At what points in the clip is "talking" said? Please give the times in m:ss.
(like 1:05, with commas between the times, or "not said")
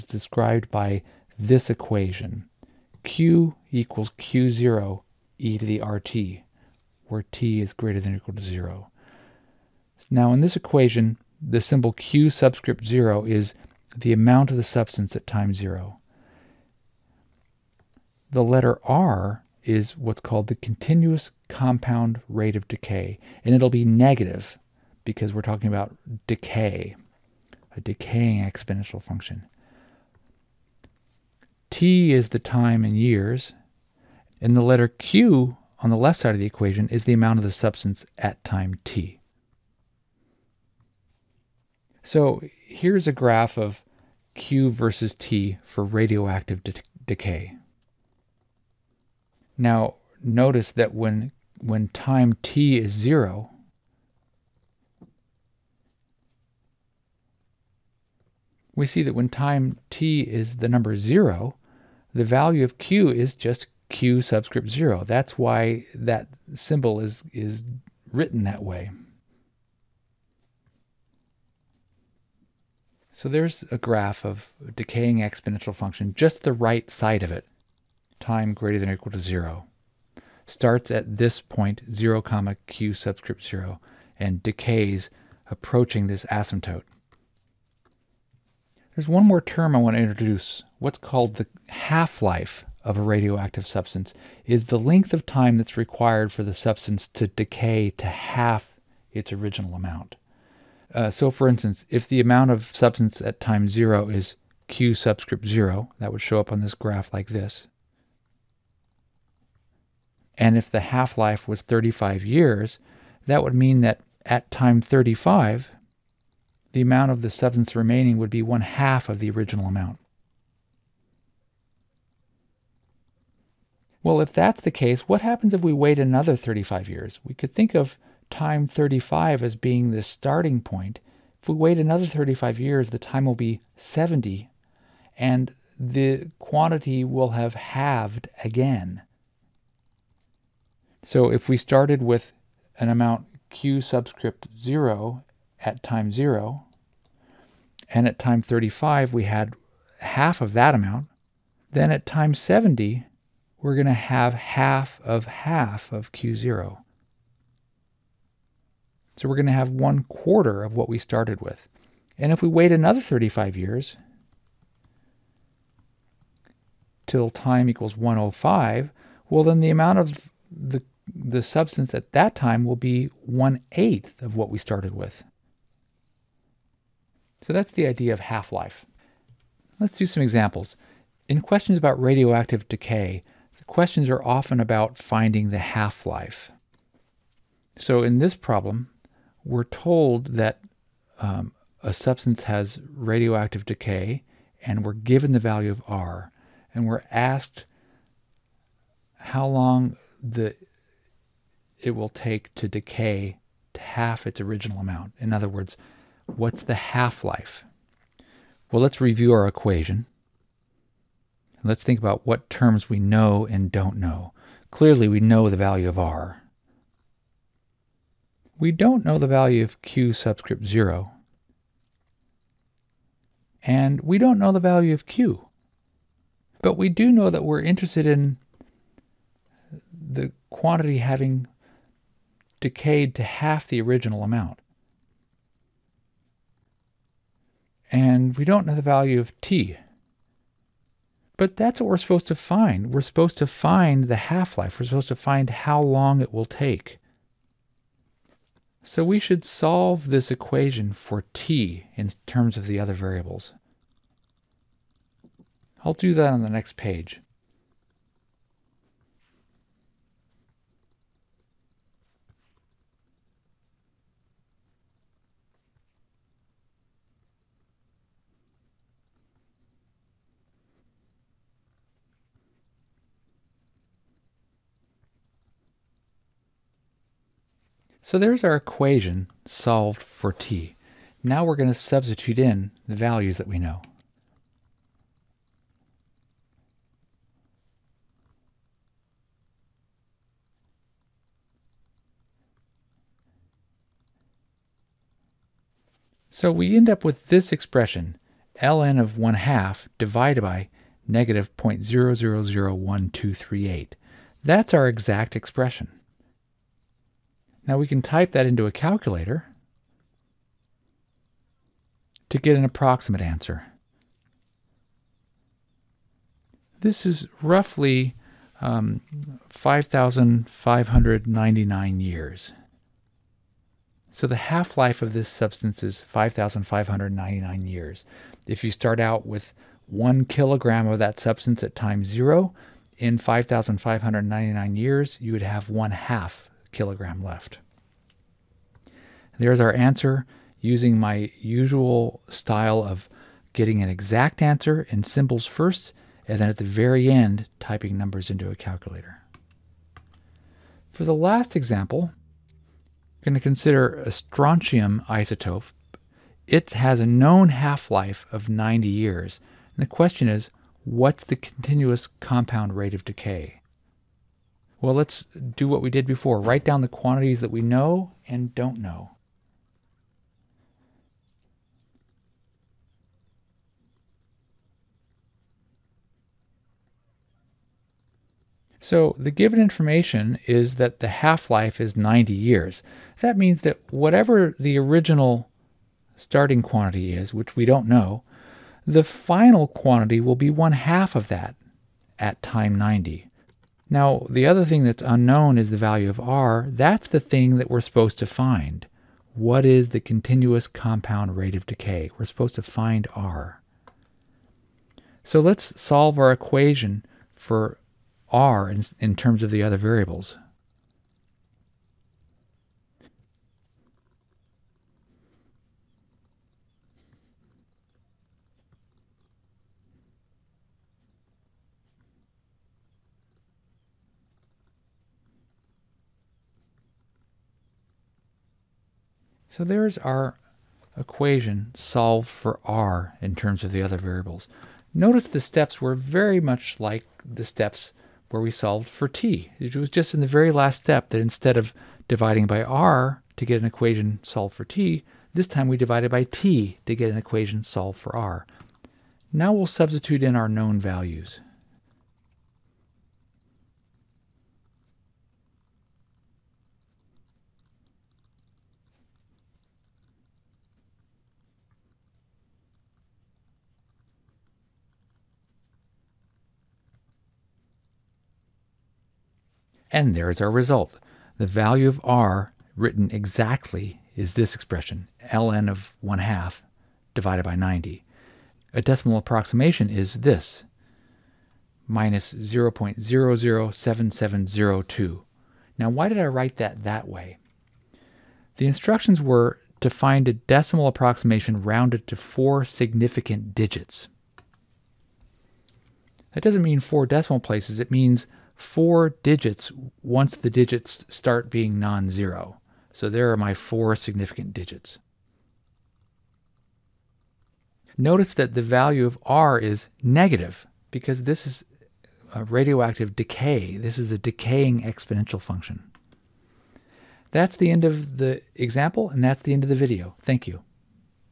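0:25.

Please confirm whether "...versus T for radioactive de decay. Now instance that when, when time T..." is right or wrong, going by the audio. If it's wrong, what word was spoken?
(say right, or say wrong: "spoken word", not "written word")
wrong: "notice", not "instance".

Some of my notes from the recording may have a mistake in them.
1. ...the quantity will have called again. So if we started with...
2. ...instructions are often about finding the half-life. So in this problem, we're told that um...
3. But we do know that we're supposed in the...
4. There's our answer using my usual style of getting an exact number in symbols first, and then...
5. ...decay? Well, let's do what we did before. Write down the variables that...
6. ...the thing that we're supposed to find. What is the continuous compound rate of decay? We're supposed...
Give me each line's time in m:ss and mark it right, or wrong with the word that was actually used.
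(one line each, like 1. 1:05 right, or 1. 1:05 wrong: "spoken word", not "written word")
1. 2:15 wrong: "halved", not "called"
2. 3:03 wrong: "questions", not "instructions"
3. 3:46 wrong: "interested", not "supposed"
4. 5:39 wrong: "answer", not "number"
5. 6:03 wrong: "quantities", not "variables"
6. 6:37 right.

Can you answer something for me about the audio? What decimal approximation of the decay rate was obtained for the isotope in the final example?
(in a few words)
-0.007702.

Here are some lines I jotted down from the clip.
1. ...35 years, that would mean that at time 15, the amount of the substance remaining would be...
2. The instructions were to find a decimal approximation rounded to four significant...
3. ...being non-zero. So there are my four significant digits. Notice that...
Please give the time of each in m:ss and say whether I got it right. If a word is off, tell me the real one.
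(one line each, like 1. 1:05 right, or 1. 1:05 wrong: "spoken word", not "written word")
1. 1:51 wrong: "35", not "15"
2. 8:08 right
3. 8:21 right.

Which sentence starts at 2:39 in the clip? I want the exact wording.
So we're going to have one quarter of what we started with.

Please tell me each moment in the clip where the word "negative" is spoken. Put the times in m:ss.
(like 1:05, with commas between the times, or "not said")
0:23, 5:01, 8:30.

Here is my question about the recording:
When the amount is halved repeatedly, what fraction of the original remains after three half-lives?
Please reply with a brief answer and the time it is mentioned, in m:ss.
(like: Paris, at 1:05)
one eighth, at 2:53.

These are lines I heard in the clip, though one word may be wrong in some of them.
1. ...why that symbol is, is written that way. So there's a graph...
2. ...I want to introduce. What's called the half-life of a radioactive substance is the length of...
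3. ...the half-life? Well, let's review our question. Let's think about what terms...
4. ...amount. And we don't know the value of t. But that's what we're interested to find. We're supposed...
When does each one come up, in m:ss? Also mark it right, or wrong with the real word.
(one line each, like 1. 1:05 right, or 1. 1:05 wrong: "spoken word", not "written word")
1. 1:05 right
2. 1:29 right
3. 3:26 wrong: "equation", not "question"
4. 3:54 wrong: "supposed", not "interested".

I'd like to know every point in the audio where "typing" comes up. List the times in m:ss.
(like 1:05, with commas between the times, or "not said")
5:47.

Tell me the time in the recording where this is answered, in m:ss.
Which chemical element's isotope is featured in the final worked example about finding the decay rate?
5:54.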